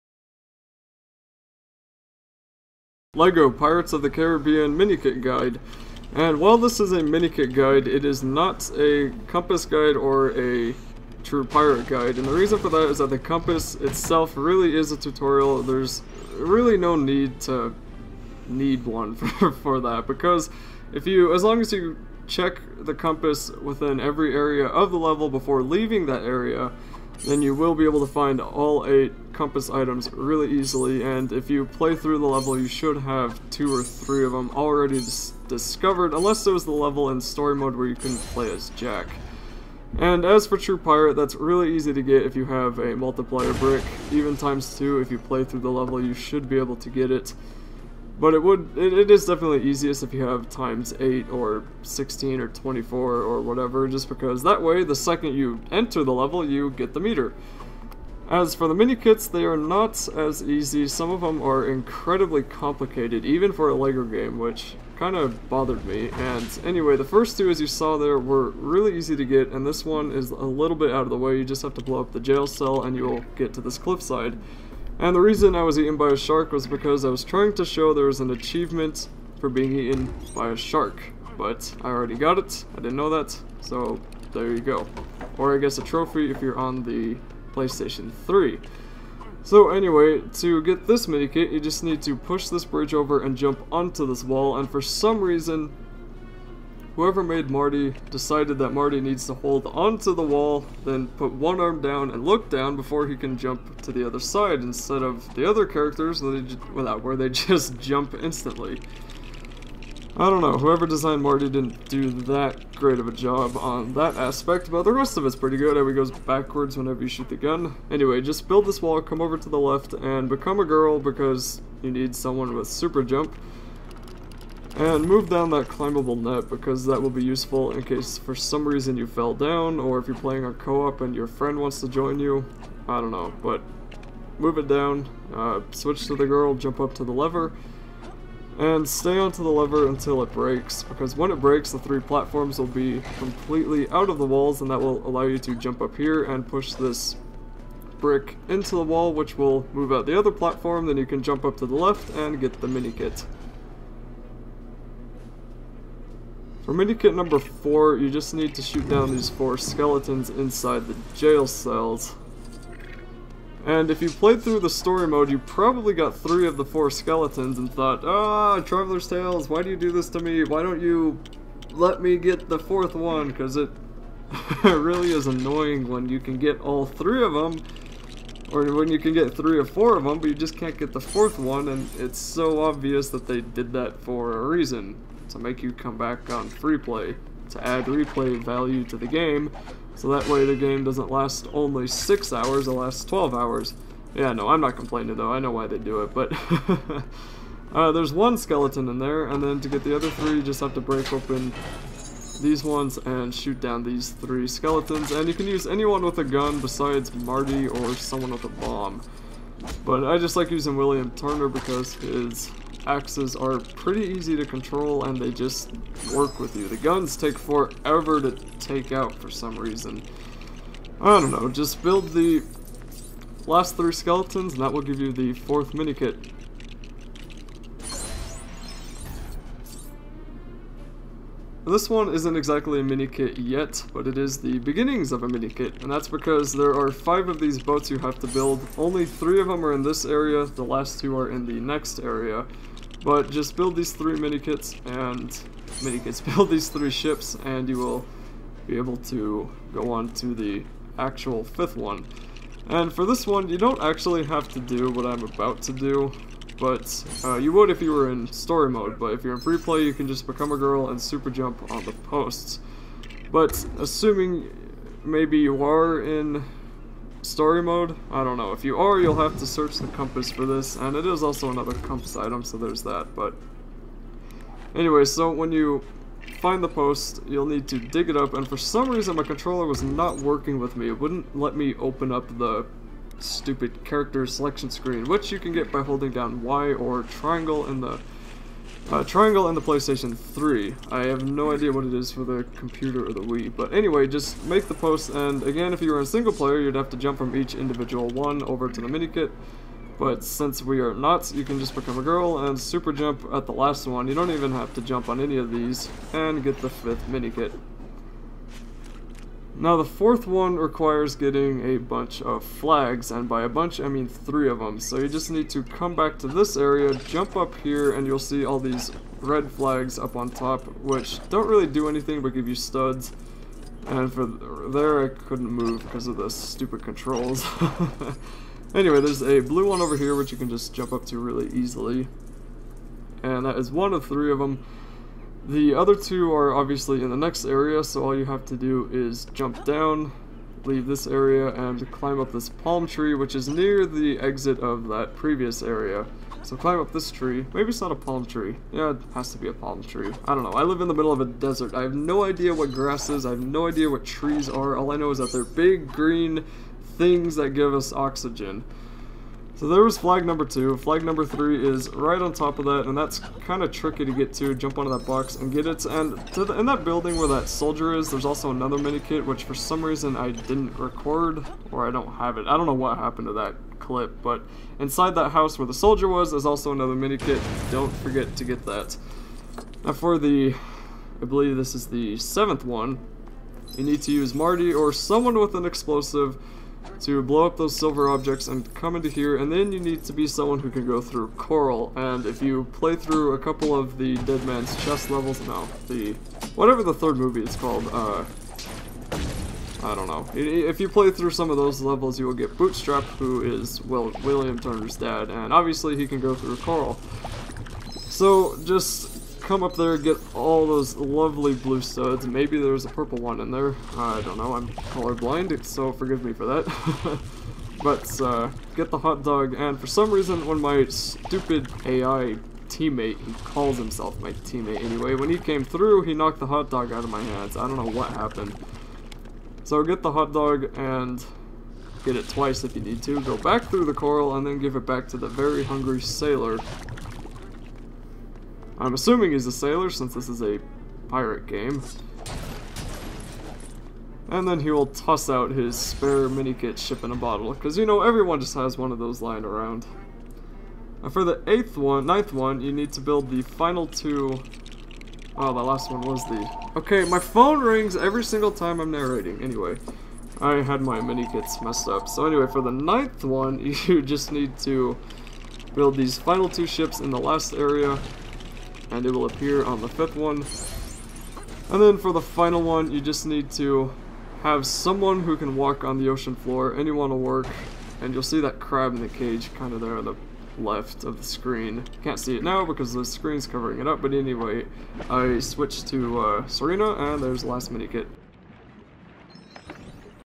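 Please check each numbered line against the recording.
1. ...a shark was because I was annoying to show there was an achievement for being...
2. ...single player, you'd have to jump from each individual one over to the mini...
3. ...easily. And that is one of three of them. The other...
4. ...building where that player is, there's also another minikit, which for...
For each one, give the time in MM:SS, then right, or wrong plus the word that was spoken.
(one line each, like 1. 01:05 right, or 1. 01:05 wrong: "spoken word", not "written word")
1. 01:16 wrong: "trying", not "annoying"
2. 04:56 right
3. 05:31 right
4. 06:06 wrong: "soldier", not "player".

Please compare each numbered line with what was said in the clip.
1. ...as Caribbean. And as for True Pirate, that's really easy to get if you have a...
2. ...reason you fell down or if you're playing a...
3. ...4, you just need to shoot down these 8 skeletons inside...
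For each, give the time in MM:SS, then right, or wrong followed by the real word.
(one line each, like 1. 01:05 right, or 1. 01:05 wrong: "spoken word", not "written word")
1. 00:38 wrong: "Jack", not "Caribbean"
2. 02:08 right
3. 02:37 wrong: "4", not "8".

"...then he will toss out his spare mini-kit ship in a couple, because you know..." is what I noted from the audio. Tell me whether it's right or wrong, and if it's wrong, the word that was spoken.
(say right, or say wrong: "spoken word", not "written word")
wrong: "bottle", not "couple".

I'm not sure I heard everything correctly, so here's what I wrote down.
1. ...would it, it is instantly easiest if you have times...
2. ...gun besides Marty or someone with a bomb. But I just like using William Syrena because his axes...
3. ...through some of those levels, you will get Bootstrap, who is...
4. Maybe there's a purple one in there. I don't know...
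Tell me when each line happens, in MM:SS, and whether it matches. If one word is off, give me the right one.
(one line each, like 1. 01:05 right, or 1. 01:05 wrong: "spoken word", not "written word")
1. 00:48 wrong: "definitely", not "instantly"
2. 03:26 wrong: "Turner", not "Syrena"
3. 06:41 right
4. 06:52 right.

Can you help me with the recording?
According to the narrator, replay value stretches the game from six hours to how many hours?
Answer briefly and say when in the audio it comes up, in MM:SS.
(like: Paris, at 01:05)
12, at 03:13.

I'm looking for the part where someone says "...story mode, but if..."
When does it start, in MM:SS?
04:18.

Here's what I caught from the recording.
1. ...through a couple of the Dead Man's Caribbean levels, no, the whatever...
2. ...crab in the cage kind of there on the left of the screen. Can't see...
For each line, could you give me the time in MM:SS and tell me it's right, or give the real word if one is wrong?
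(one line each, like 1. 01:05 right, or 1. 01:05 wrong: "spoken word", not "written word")
1. 06:32 wrong: "Chest", not "Caribbean"
2. 07:58 right.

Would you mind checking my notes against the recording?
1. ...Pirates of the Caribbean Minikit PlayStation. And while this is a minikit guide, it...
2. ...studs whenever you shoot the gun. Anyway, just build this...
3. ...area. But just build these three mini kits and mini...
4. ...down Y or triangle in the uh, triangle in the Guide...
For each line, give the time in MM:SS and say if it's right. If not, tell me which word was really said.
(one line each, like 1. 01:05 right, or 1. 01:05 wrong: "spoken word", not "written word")
1. 00:03 wrong: "Guide", not "PlayStation"
2. 01:56 wrong: "backwards", not "studs"
3. 04:01 right
4. 04:46 wrong: "PlayStation", not "Guide".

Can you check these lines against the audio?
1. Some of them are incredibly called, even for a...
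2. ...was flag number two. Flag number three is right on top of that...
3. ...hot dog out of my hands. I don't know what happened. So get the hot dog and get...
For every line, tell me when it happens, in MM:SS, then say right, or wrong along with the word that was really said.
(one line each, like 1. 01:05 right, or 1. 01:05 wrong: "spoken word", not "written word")
1. 01:00 wrong: "complicated", not "called"
2. 05:59 right
3. 07:06 right.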